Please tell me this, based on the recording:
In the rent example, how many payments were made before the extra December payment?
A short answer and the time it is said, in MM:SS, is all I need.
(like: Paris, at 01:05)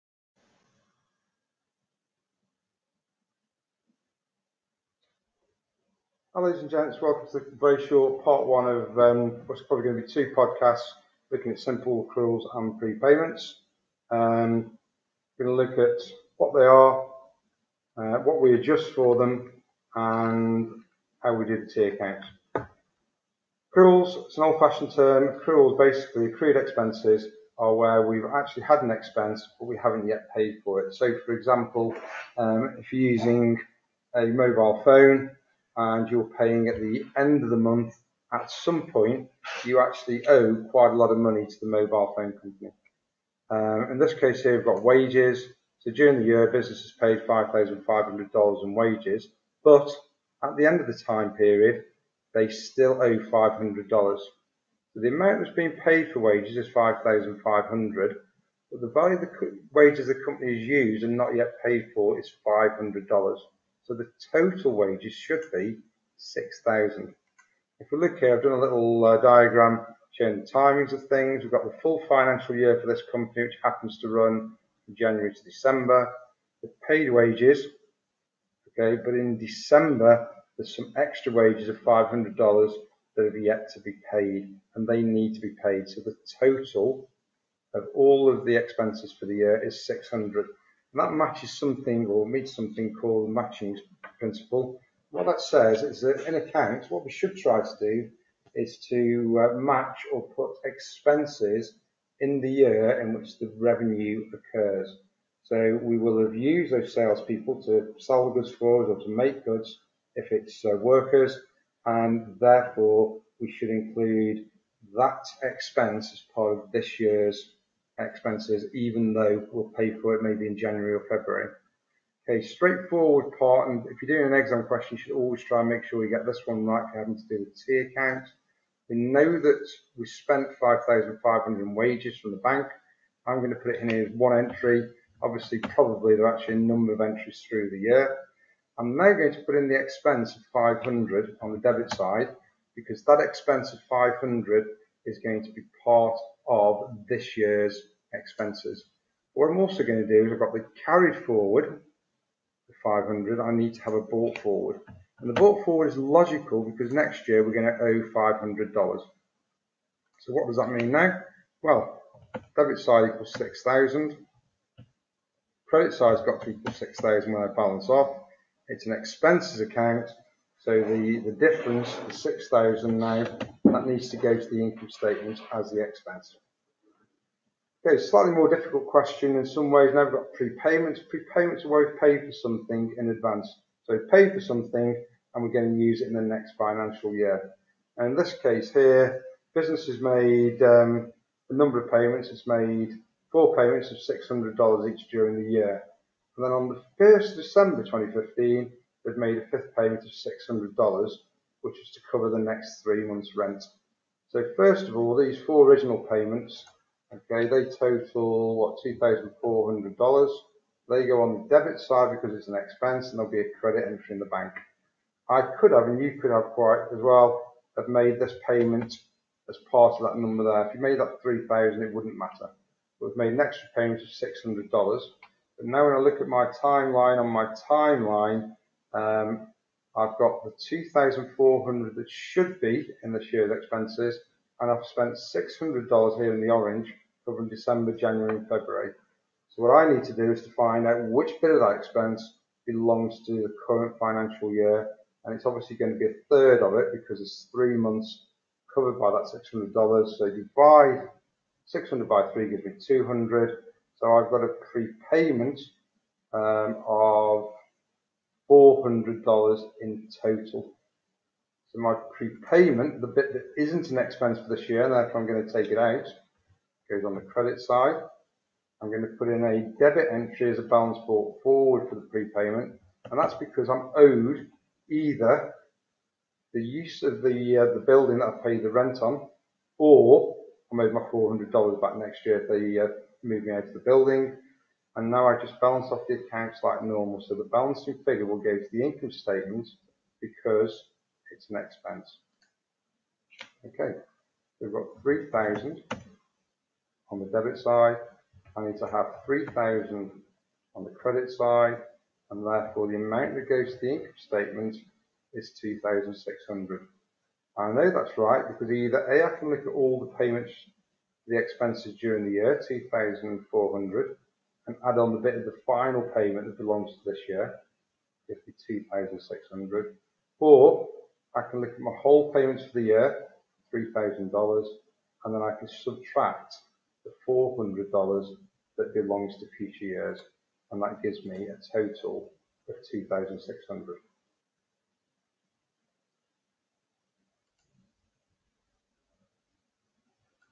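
4, at 03:13.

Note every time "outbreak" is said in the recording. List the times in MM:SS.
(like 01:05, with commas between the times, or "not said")
not said.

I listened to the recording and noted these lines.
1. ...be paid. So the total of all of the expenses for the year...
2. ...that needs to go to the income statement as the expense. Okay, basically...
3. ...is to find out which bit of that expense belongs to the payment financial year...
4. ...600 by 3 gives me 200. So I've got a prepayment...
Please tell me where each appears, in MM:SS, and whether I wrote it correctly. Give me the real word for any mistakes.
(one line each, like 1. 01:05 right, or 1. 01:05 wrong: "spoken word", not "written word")
1. 01:25 right
2. 02:53 wrong: "slightly", not "basically"
3. 04:00 wrong: "current", not "payment"
4. 04:11 right.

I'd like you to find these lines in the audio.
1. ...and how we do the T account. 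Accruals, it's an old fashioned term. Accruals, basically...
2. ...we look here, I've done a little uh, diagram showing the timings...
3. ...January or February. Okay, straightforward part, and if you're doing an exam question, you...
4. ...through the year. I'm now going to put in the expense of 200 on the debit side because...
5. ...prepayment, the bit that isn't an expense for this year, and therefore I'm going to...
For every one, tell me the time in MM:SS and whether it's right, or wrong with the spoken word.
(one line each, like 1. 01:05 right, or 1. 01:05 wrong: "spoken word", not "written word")
1. 00:19 right
2. 01:07 right
3. 02:00 right
4. 02:17 wrong: "500", not "200"
5. 04:22 right.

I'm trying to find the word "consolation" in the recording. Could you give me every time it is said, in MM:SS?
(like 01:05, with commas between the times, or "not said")
not said.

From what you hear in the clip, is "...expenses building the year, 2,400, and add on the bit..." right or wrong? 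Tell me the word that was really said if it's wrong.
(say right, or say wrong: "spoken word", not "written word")
wrong: "during", not "building".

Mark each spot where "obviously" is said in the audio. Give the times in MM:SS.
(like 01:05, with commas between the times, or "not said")
02:15, 04:05.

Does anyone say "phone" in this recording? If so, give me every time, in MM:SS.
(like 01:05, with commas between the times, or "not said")
00:34, 00:42.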